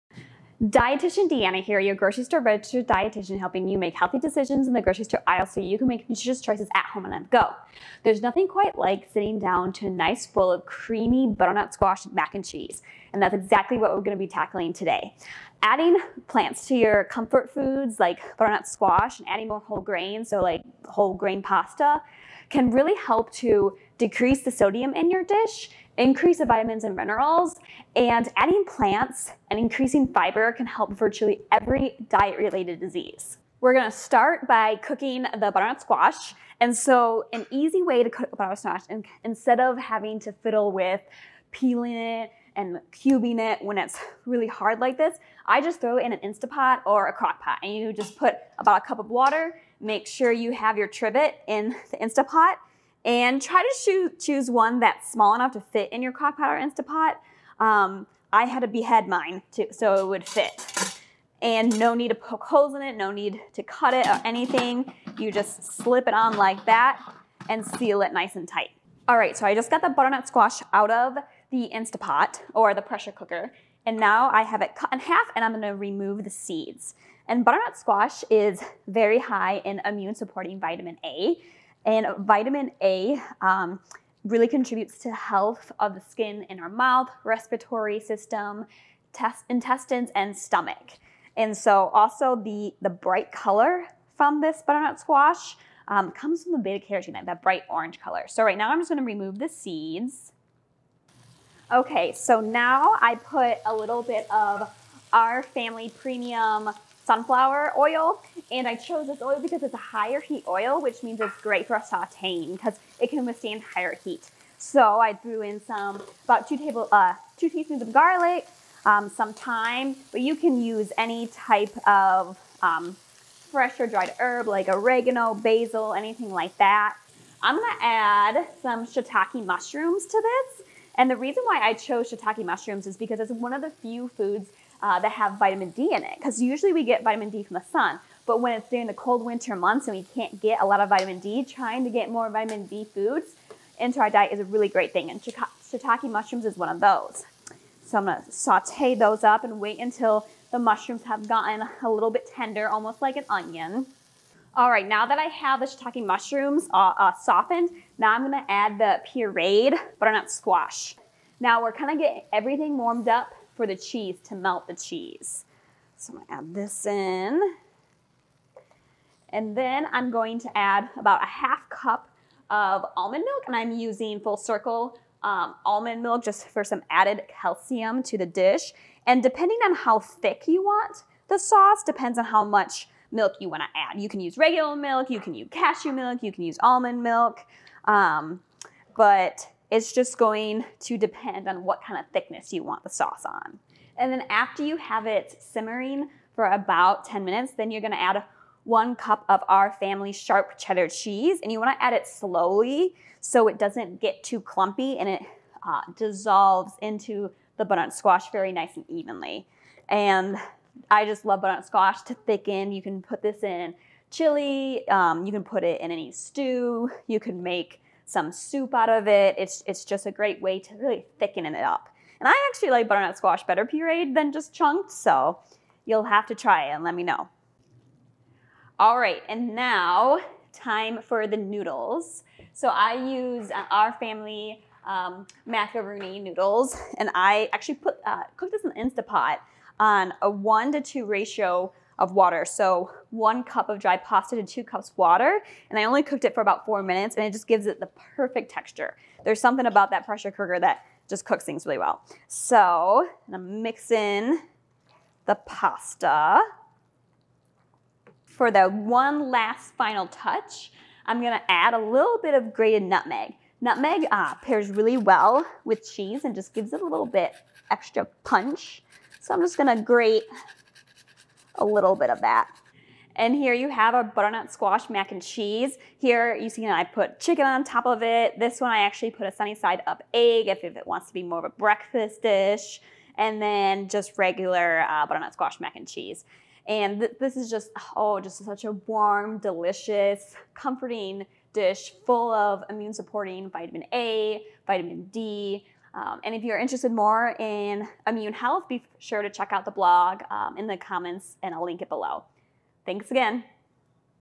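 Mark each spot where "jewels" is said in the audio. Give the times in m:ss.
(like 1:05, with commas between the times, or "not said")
not said.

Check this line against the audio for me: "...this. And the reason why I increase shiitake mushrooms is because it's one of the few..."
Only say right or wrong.
wrong.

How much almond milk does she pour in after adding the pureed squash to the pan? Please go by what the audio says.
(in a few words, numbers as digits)
half cup.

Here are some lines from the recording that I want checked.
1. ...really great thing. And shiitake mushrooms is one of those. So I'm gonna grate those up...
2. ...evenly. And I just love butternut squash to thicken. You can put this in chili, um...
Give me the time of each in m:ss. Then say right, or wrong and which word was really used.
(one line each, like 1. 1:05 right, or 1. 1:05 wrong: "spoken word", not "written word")
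1. 2:24 wrong: "saute", not "grate"
2. 3:28 right.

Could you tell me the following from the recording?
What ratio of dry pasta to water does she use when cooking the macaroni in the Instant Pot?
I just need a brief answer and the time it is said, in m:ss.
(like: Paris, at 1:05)
1 to 2, at 4:00.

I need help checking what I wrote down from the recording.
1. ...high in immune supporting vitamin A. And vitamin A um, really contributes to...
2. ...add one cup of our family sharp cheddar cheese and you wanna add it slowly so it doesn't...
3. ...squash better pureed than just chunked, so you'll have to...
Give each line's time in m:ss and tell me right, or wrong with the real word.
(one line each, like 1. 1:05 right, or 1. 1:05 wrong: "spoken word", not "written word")
1. 1:19 right
2. 3:17 right
3. 3:43 right.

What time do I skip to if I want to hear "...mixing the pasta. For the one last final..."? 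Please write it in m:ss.
4:13.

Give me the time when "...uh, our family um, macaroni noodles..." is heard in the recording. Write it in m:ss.
3:53.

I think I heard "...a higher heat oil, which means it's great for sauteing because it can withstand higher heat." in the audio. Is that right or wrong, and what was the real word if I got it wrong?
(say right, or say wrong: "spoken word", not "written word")
right.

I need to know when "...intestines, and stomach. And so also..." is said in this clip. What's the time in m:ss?
1:29.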